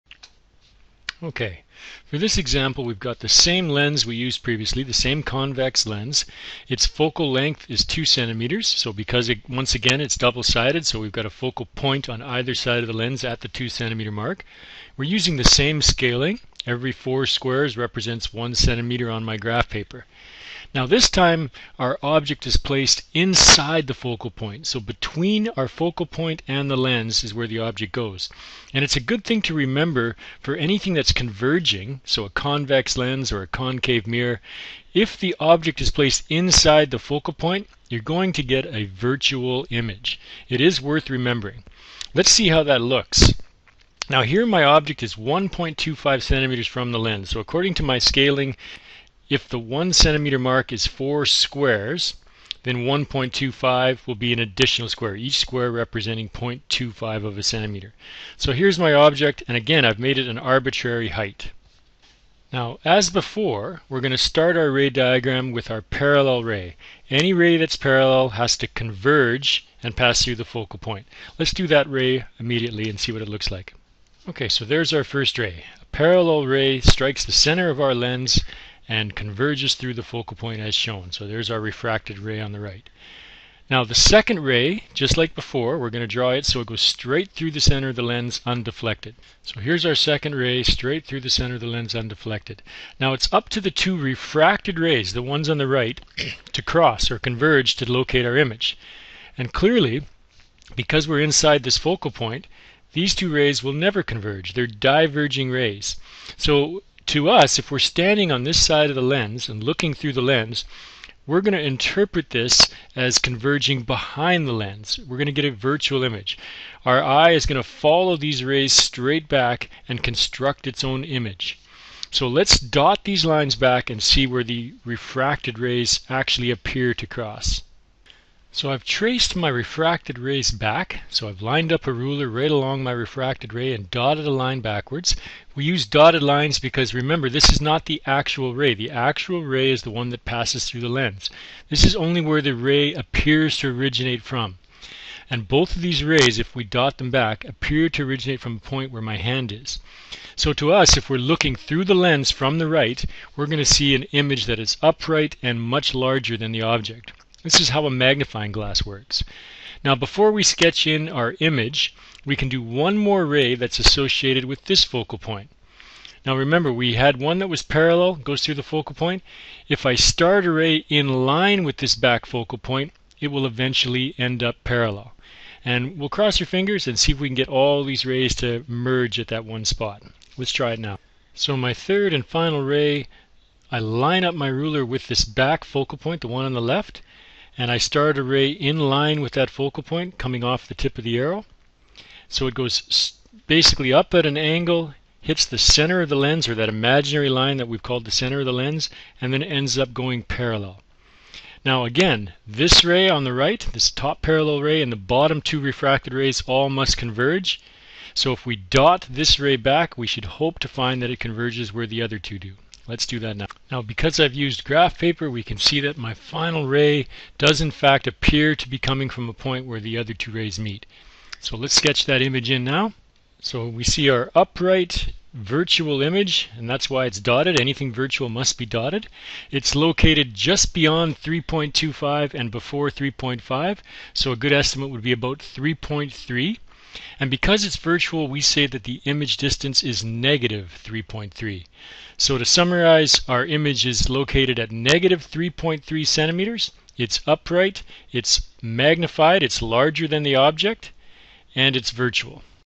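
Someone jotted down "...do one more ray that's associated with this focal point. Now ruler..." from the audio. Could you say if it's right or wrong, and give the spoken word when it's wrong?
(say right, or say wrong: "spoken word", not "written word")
wrong: "remember", not "ruler".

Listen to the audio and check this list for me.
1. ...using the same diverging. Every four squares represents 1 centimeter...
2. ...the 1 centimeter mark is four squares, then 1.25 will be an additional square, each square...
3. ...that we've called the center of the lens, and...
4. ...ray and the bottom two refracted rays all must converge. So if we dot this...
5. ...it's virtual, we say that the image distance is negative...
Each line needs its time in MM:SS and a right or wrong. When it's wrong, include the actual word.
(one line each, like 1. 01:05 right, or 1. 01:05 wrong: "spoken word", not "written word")
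1. 00:15 wrong: "scaling", not "diverging"
2. 00:49 right
3. 03:17 right
4. 03:24 right
5. 03:57 right.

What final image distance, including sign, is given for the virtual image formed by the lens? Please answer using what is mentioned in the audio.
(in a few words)
-3.3 centimeters.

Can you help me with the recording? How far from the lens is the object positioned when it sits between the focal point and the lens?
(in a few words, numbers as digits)
1.25 centimeters.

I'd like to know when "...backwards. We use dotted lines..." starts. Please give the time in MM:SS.
02:14.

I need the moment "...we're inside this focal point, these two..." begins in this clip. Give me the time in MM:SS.
01:41.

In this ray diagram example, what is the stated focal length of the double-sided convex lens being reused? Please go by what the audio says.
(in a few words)
2 centimeters.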